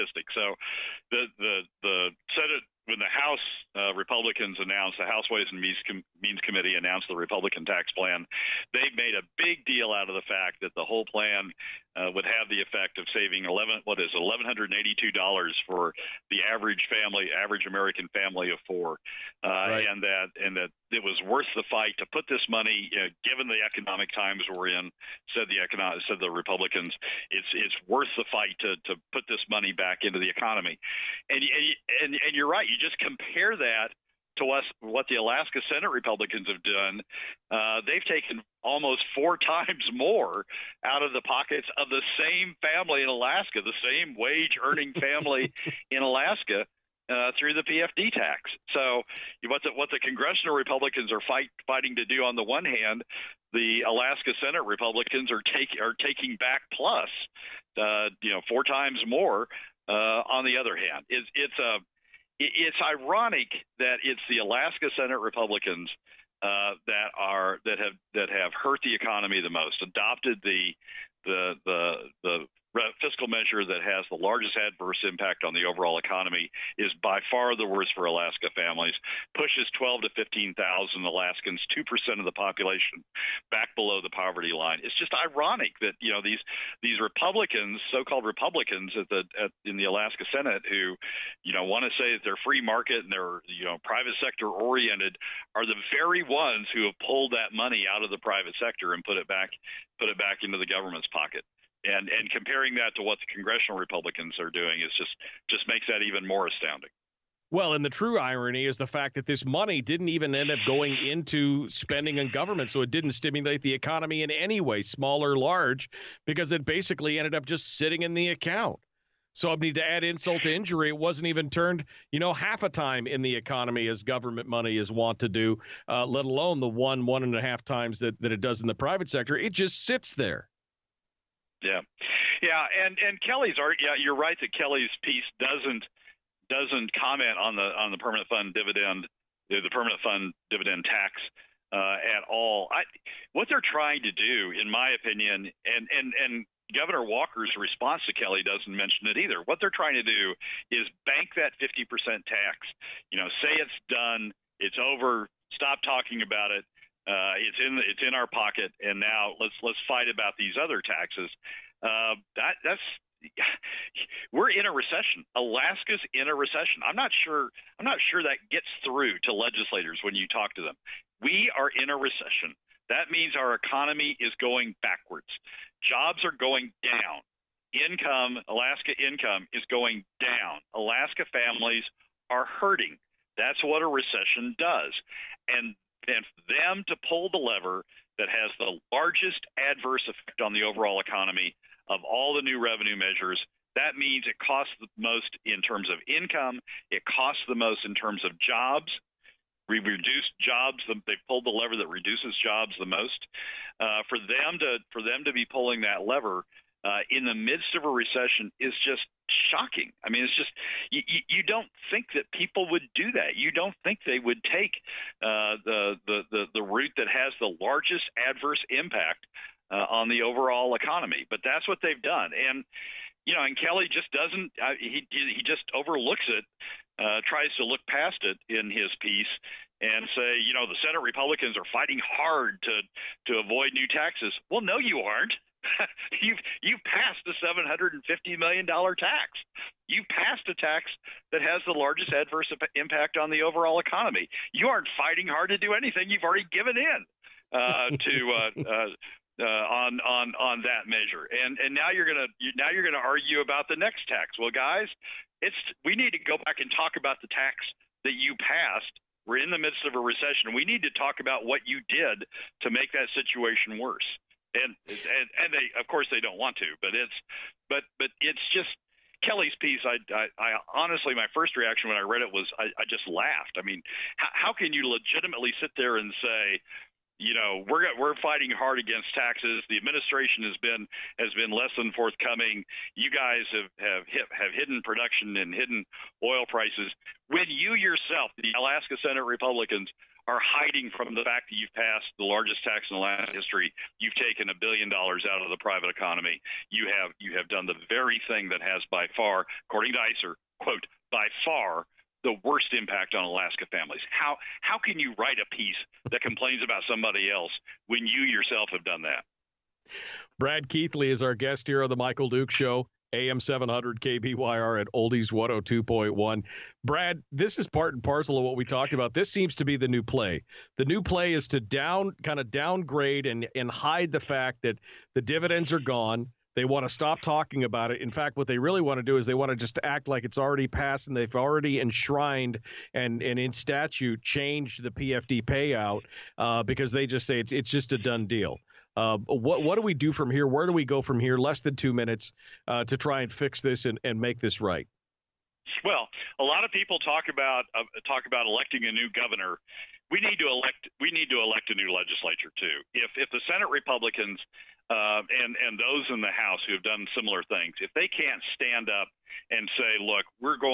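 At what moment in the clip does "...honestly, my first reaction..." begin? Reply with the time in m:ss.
4:30.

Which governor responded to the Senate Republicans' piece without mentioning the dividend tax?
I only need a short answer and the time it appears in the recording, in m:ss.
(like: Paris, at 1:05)
Governor Walker, at 2:26.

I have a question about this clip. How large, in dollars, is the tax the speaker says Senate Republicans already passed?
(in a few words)
$750 million.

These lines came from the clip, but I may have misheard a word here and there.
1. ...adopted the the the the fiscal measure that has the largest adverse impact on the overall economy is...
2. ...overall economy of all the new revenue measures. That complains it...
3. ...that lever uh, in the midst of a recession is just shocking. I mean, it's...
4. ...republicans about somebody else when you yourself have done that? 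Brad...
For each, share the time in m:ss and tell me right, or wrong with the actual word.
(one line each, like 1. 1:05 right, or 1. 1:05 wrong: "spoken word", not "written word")
1. 1:09 right
2. 3:10 wrong: "means", not "complains"
3. 3:25 right
4. 5:06 wrong: "complains", not "republicans".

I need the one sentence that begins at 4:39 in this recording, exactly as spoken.
The administration has been has been less than forthcoming.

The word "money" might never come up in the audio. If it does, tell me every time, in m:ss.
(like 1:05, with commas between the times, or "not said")
0:22, 0:29, 1:37, 1:49, 2:04.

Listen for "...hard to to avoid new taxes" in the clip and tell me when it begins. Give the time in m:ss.
3:51.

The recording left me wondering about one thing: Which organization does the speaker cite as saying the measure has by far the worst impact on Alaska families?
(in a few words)
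ISER.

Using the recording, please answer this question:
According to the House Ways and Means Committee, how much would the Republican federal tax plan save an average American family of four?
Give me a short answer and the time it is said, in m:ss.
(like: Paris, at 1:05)
$1182, at 0:14.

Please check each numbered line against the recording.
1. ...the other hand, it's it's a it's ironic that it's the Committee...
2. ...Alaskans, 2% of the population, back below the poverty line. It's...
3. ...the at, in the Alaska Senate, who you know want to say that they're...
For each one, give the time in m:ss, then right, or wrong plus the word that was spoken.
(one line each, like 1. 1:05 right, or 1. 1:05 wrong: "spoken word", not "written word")
1. 1:00 wrong: "Alaska", not "Committee"
2. 1:21 right
3. 1:29 right.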